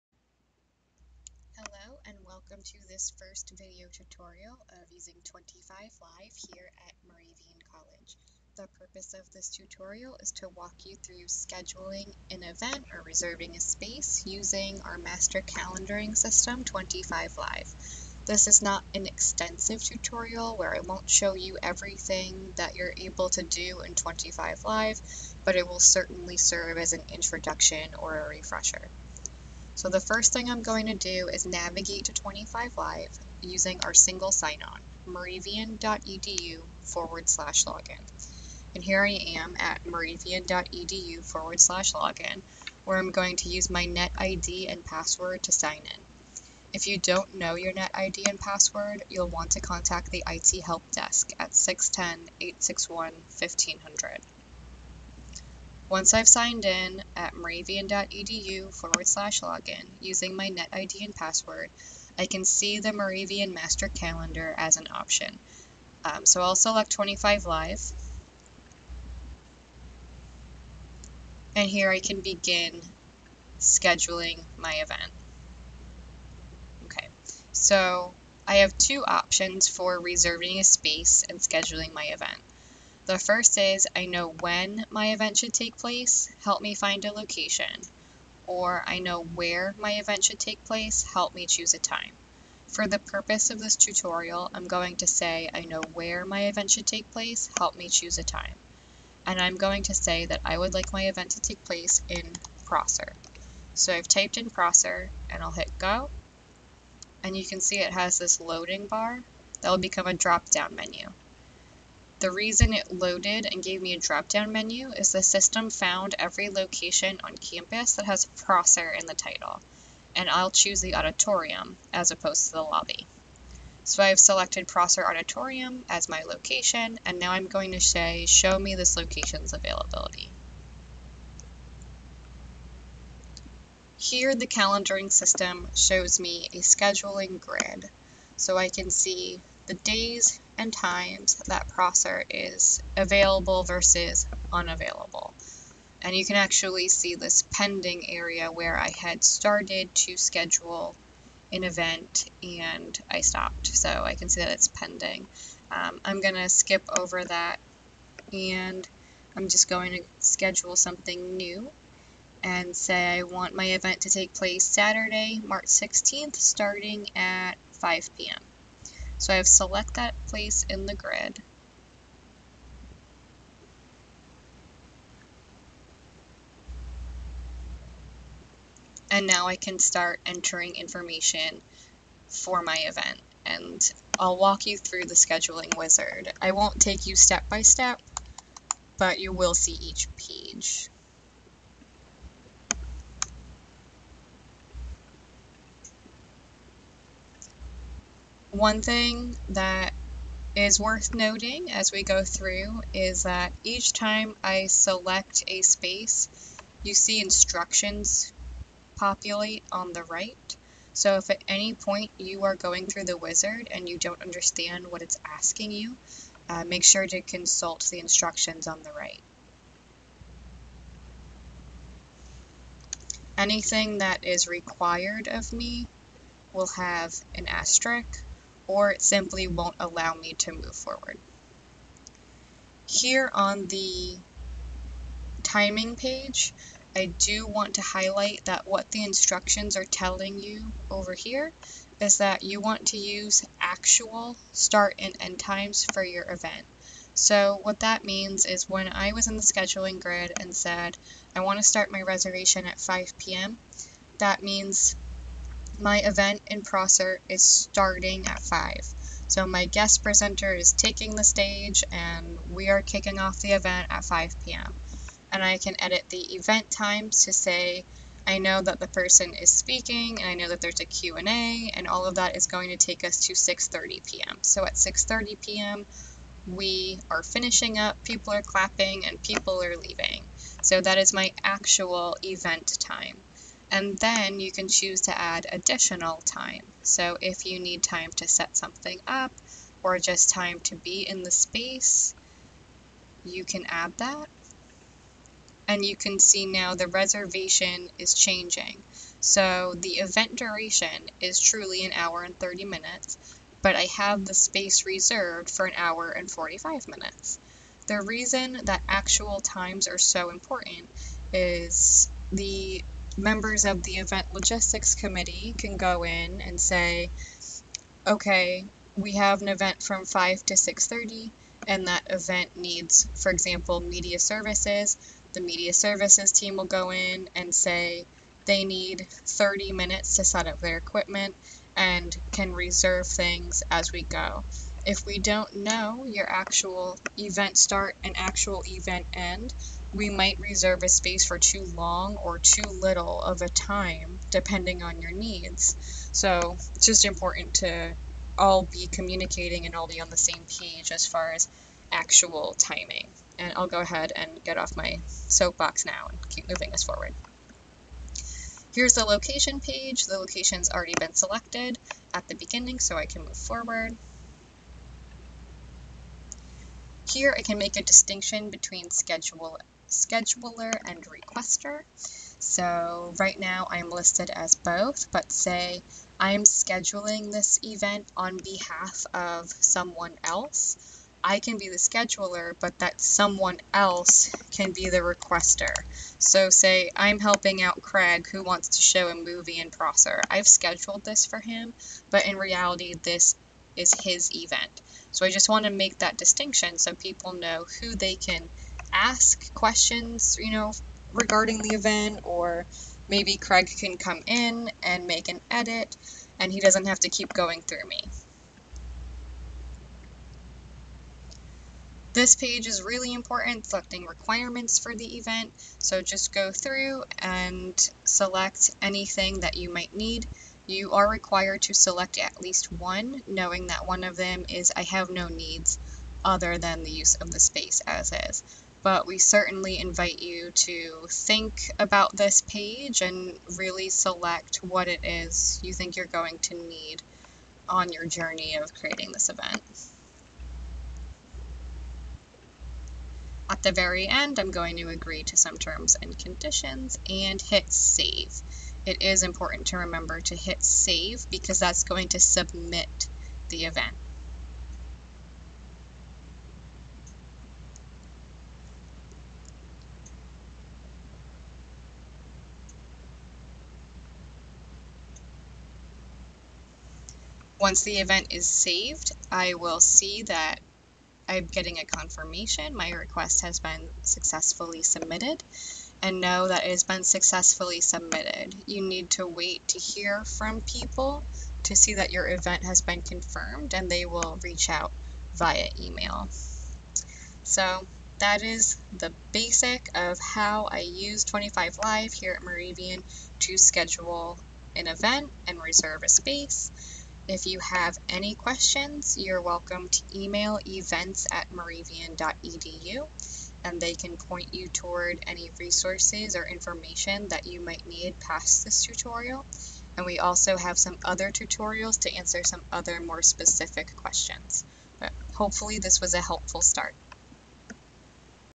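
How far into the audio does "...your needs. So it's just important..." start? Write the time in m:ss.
5:45.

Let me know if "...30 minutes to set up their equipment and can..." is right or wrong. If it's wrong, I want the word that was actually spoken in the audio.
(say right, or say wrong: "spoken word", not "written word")
right.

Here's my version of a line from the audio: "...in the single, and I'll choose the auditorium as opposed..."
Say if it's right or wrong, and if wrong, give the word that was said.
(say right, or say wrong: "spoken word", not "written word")
wrong: "title", not "single".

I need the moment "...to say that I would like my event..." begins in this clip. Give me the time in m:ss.
1:39.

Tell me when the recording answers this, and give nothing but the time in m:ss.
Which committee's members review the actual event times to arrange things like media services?
5:13.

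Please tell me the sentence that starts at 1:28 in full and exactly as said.
Or I know where my event should take place, help me choose a time.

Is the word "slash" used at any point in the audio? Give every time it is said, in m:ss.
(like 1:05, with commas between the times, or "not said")
0:37, 0:41, 0:59.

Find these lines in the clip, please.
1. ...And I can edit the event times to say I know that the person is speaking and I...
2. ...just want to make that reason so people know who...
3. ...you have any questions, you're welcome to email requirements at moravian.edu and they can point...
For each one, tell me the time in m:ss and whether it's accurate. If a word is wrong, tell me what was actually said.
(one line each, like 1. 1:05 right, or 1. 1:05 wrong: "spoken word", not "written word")
1. 4:25 right
2. 6:35 wrong: "distinction", not "reason"
3. 8:17 wrong: "events", not "requirements".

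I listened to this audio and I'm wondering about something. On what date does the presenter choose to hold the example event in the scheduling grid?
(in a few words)
Saturday, March 16th.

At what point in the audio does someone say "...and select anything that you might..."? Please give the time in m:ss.
6:57.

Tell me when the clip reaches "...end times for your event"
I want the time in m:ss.
4:05.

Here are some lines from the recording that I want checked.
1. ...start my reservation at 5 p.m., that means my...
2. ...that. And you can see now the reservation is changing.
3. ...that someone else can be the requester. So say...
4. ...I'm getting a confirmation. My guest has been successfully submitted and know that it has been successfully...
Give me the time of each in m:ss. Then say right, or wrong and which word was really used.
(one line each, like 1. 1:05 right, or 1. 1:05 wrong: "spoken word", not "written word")
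1. 4:11 right
2. 4:53 right
3. 6:22 right
4. 7:51 wrong: "request", not "guest".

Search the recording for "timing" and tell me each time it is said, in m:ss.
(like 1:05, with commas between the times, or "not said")
3:55, 5:52.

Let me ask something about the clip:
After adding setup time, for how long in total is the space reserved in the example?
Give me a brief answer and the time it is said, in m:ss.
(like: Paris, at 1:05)
1 hour 45 minutes, at 5:05.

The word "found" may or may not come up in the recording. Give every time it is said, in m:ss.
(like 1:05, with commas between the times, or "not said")
1:55.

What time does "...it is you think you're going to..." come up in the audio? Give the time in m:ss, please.
7:14.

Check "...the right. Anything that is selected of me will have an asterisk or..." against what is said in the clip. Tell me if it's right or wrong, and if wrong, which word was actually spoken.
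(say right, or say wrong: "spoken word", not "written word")
wrong: "required", not "selected".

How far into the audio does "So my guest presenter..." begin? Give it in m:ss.
4:19.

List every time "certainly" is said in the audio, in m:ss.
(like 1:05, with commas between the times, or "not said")
0:25, 7:09.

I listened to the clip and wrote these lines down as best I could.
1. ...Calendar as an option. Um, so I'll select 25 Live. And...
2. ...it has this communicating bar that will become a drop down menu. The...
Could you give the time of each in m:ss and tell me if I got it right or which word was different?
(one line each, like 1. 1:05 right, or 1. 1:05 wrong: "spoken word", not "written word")
1. 1:03 right
2. 1:47 wrong: "loading", not "communicating".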